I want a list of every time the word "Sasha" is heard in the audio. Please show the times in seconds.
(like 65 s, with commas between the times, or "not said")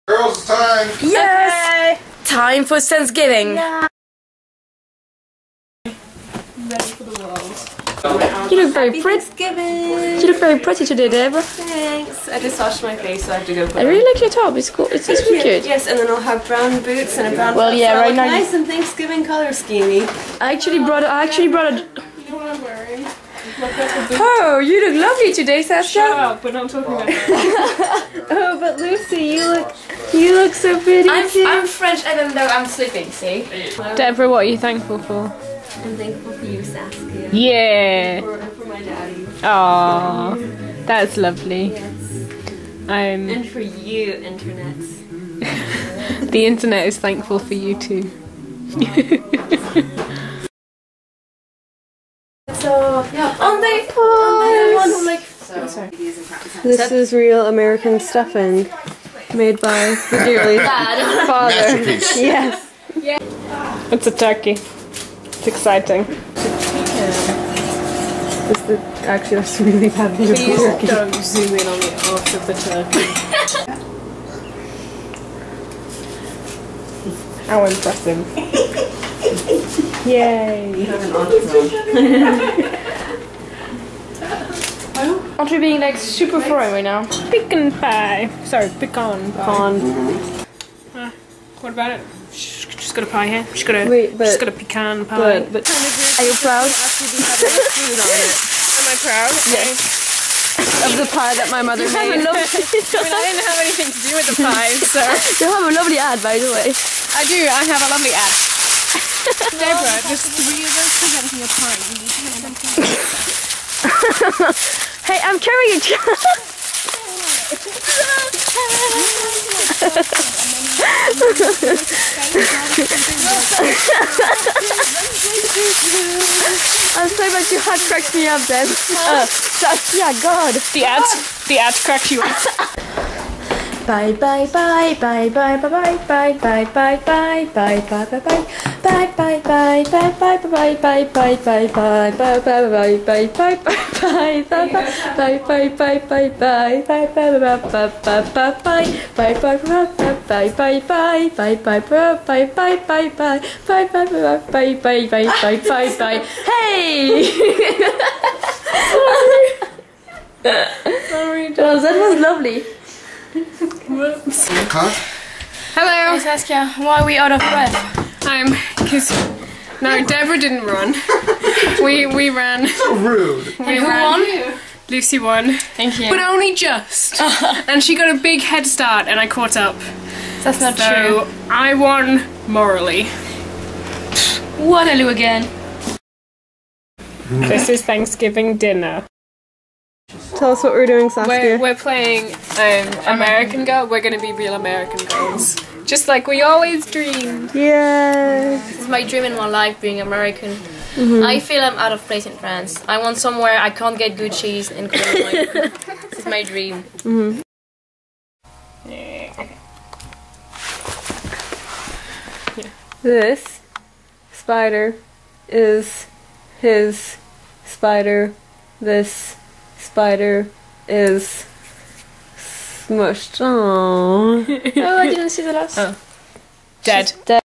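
25 s.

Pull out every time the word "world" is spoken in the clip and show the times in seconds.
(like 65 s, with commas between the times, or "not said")
7 s.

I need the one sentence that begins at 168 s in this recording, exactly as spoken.
I'm because no, Deborah didn't run.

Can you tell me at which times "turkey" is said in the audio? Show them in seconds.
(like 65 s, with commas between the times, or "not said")
64 s, 72 s.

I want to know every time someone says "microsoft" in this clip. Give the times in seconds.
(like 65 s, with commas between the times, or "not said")
not said.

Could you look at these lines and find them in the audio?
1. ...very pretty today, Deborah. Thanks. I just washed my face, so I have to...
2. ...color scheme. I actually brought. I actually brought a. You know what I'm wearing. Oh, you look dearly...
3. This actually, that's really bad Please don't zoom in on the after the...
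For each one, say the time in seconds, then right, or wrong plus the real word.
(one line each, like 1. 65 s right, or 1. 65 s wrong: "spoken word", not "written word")
1. 10 s right
2. 19 s wrong: "lovely", not "dearly"
3. 68 s right.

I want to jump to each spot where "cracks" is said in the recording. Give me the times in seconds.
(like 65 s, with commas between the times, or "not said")
127 s, 131 s.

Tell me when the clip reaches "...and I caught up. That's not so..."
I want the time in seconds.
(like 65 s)
179 s.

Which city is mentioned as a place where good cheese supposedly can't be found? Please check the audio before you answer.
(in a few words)
Cologne.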